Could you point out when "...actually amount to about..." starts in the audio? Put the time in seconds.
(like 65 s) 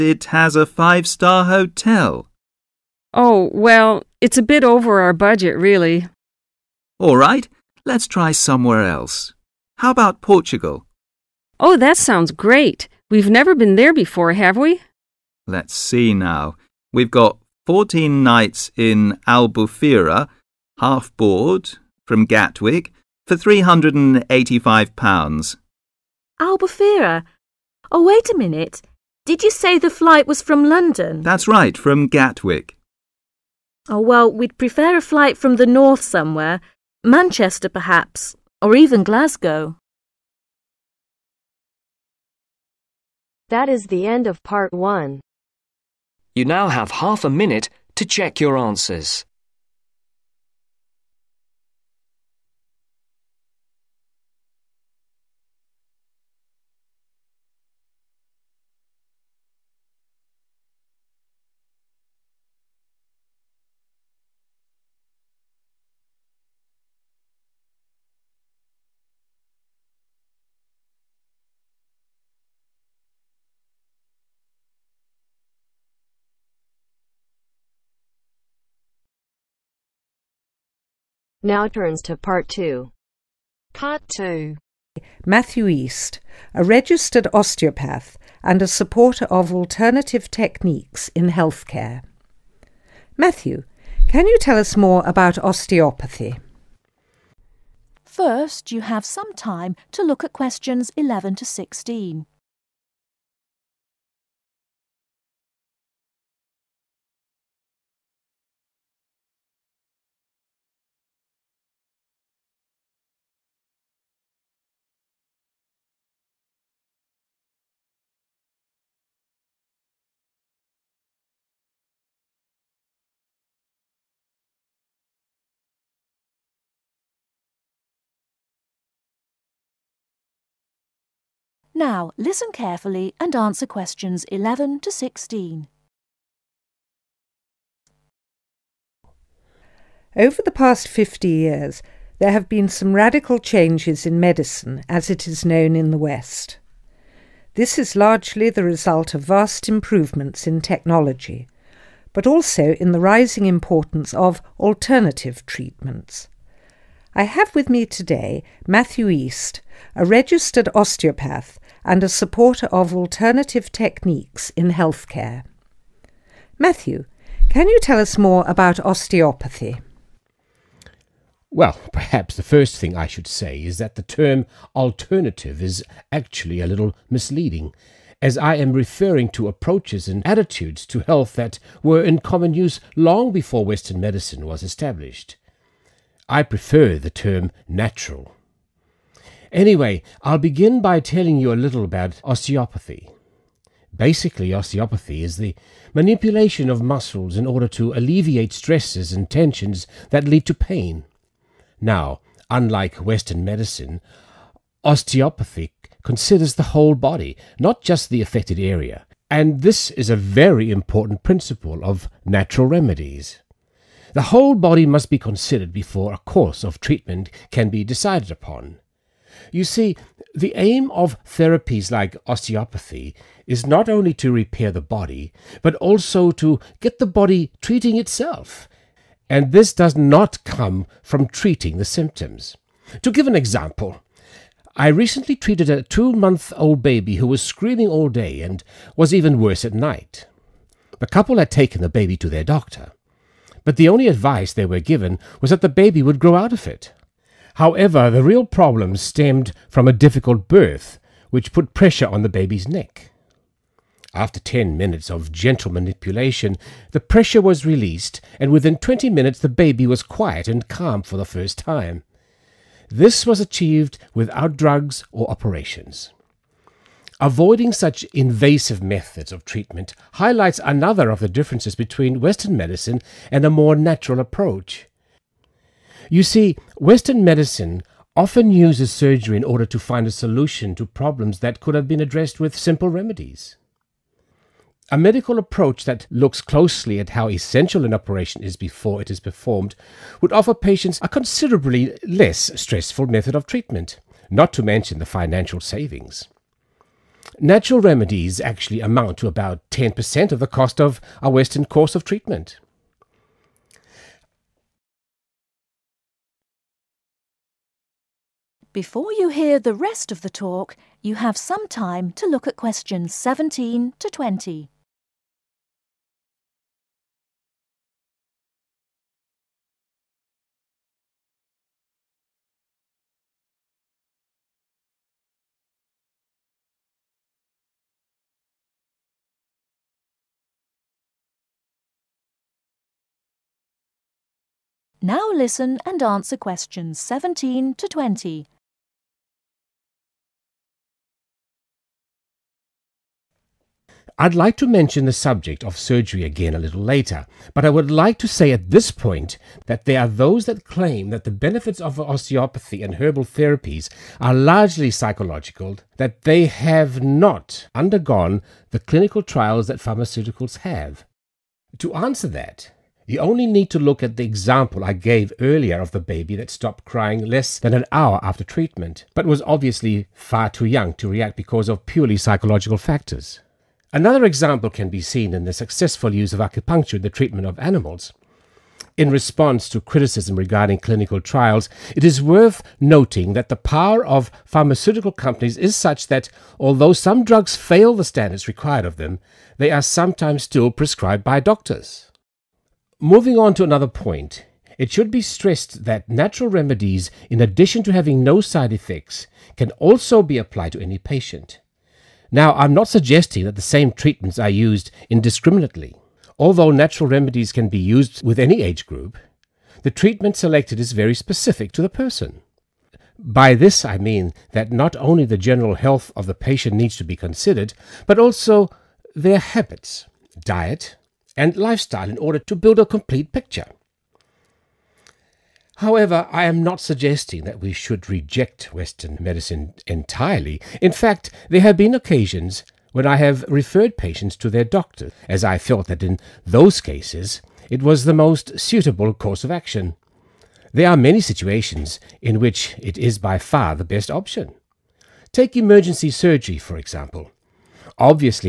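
298 s.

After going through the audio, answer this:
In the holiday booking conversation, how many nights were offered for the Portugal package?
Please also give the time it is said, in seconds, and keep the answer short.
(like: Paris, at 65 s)
14, at 17 s.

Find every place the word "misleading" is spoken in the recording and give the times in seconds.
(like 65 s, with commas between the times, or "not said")
177 s.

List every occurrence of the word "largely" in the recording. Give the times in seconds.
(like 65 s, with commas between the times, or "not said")
147 s, 354 s.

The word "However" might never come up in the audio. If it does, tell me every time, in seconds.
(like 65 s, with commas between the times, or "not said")
247 s, 425 s.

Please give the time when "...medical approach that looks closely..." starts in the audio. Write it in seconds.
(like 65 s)
284 s.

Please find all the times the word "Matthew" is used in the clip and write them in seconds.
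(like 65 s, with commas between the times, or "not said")
85 s, 93 s, 158 s, 166 s.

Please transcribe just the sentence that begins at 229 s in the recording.
And this does not come from treating the symptoms.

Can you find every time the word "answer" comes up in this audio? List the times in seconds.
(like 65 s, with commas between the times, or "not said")
48 s, 133 s, 336 s, 361 s.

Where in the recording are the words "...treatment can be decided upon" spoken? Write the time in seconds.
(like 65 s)
216 s.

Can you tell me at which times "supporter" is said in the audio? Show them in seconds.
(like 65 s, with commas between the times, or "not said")
88 s, 162 s.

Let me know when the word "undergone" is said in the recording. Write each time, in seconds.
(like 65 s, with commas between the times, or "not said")
357 s.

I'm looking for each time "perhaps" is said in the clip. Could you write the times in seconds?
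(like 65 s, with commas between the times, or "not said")
37 s, 171 s.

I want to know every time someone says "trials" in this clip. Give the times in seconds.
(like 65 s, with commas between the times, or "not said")
359 s, 381 s.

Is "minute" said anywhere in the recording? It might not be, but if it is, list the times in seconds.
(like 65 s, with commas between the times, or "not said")
28 s, 47 s, 254 s, 259 s.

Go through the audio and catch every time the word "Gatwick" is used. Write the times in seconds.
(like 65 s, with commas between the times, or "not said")
22 s, 32 s.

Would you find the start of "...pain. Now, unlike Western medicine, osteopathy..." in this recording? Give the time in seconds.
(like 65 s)
200 s.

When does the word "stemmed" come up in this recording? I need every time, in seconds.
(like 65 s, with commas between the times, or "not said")
248 s.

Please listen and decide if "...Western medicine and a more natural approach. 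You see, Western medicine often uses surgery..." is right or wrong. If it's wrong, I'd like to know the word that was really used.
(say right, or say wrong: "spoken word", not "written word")
right.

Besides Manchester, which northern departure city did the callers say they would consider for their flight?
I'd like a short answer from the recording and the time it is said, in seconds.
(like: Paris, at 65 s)
Glasgow, at 39 s.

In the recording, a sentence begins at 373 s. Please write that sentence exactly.
Another example can be seen in the successful use of acupuncture in the treatment of animals.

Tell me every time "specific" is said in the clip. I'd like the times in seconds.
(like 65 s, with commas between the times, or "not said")
411 s.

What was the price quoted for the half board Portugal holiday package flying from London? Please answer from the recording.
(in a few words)
£385.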